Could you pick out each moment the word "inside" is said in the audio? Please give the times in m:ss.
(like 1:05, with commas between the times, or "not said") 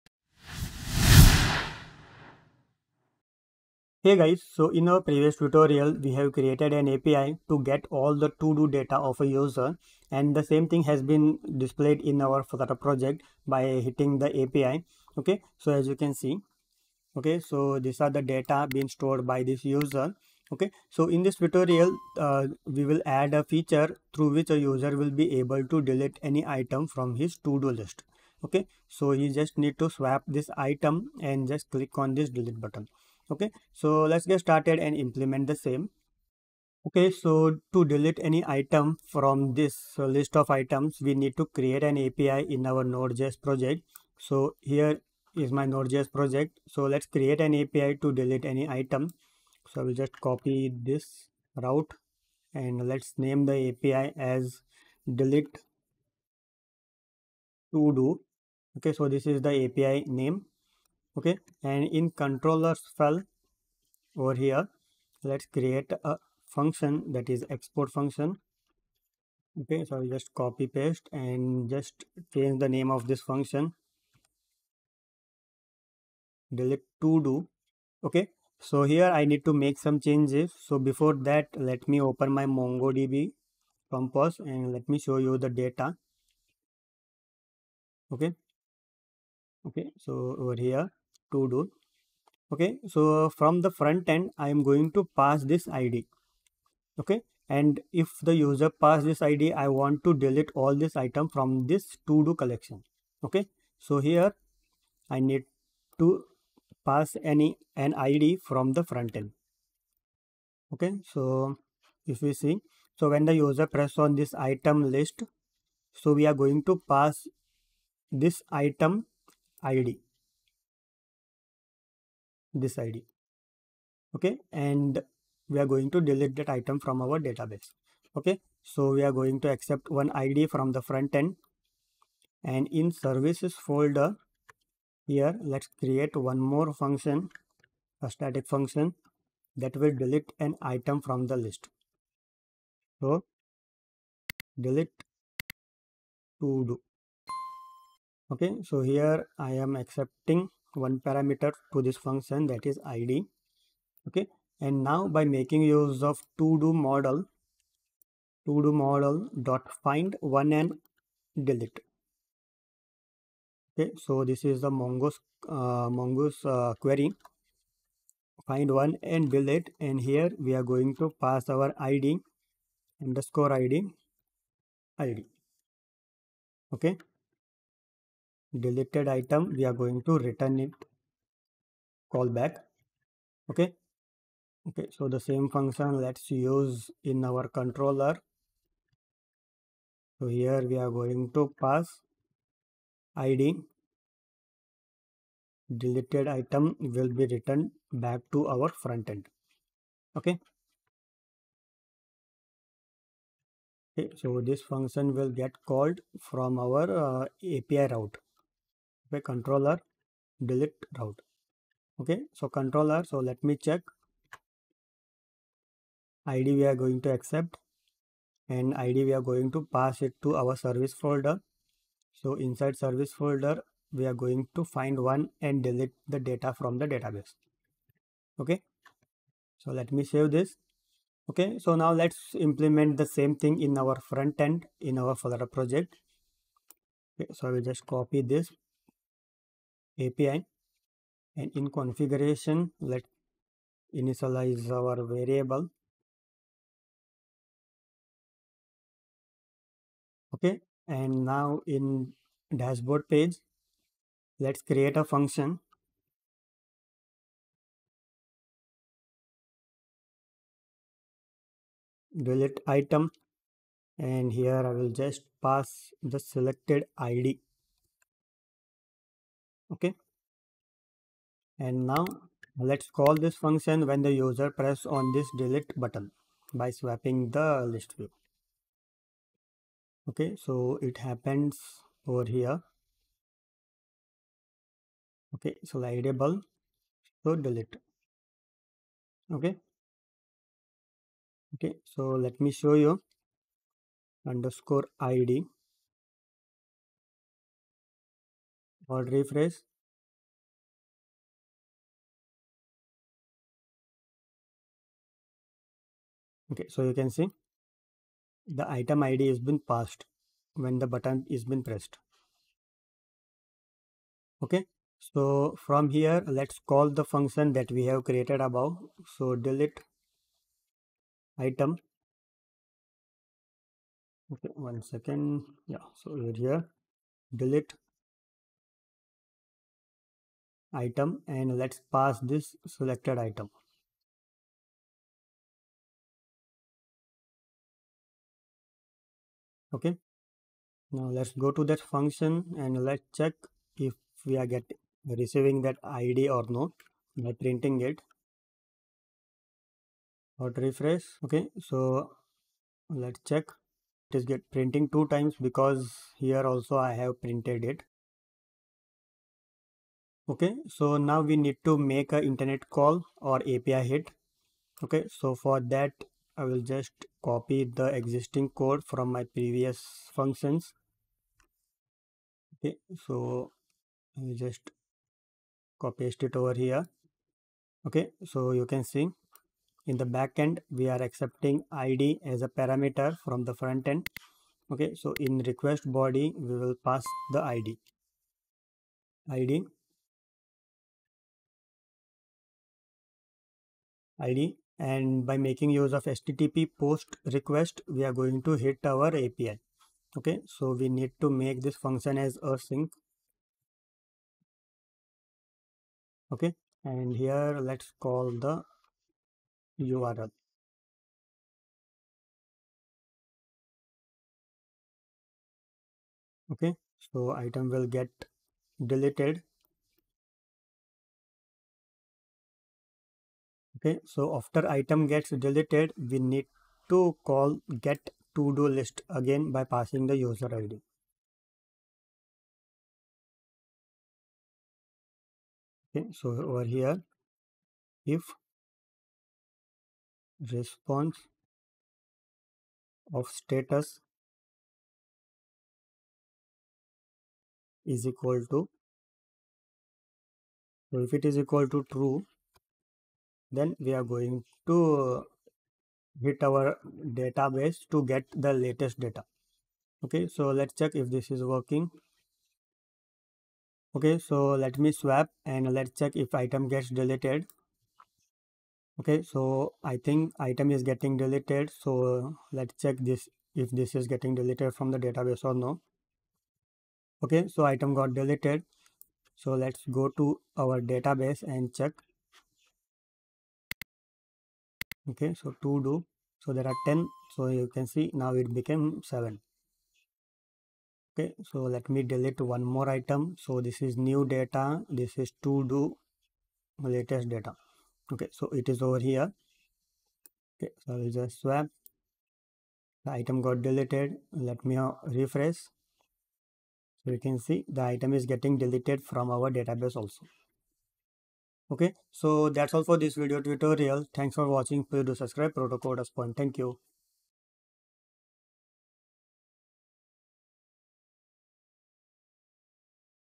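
3:42.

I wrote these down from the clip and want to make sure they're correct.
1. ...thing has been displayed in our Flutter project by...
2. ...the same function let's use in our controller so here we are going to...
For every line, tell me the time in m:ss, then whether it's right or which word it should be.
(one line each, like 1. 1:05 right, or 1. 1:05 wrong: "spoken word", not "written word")
1. 0:10 right
2. 3:05 right.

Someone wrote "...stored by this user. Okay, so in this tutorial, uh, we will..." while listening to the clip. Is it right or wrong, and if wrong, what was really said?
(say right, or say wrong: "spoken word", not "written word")
right.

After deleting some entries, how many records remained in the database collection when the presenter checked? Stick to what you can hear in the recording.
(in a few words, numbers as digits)
7.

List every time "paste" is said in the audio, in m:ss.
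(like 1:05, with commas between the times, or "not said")
1:10, 6:16.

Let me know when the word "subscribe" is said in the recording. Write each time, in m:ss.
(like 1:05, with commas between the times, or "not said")
8:35.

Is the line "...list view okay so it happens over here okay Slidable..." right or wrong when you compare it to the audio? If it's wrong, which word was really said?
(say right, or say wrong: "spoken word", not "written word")
right.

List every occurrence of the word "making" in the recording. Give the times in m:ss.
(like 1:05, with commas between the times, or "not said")
2:35, 6:35.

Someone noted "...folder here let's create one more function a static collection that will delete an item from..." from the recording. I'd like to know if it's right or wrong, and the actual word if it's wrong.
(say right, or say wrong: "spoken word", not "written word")
wrong: "function", not "collection".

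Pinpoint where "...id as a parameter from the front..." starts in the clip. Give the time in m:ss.
6:21.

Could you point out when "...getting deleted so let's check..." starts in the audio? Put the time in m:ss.
7:50.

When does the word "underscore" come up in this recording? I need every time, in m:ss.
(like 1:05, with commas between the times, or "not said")
2:53, 4:54.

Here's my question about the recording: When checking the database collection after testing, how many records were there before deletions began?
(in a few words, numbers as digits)
10.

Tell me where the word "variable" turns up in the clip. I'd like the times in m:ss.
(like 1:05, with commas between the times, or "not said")
4:05.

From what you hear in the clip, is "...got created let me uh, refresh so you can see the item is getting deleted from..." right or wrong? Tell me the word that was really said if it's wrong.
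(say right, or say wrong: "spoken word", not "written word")
wrong: "deleted", not "created".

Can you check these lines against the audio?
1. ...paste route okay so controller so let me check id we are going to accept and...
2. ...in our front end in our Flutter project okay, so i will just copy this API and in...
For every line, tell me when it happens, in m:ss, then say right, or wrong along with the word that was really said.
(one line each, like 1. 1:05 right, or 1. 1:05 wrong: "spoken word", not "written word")
1. 3:30 wrong: "delete", not "paste"
2. 3:53 right.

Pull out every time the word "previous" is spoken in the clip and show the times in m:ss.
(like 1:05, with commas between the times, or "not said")
0:04, 6:09.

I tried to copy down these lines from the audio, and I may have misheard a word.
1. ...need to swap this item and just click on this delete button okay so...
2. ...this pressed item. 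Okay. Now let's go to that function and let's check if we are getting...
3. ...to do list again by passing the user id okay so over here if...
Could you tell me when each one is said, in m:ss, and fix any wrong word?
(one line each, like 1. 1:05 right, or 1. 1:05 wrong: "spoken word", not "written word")
1. 0:29 right
2. 5:32 wrong: "selected", not "pressed"
3. 7:08 right.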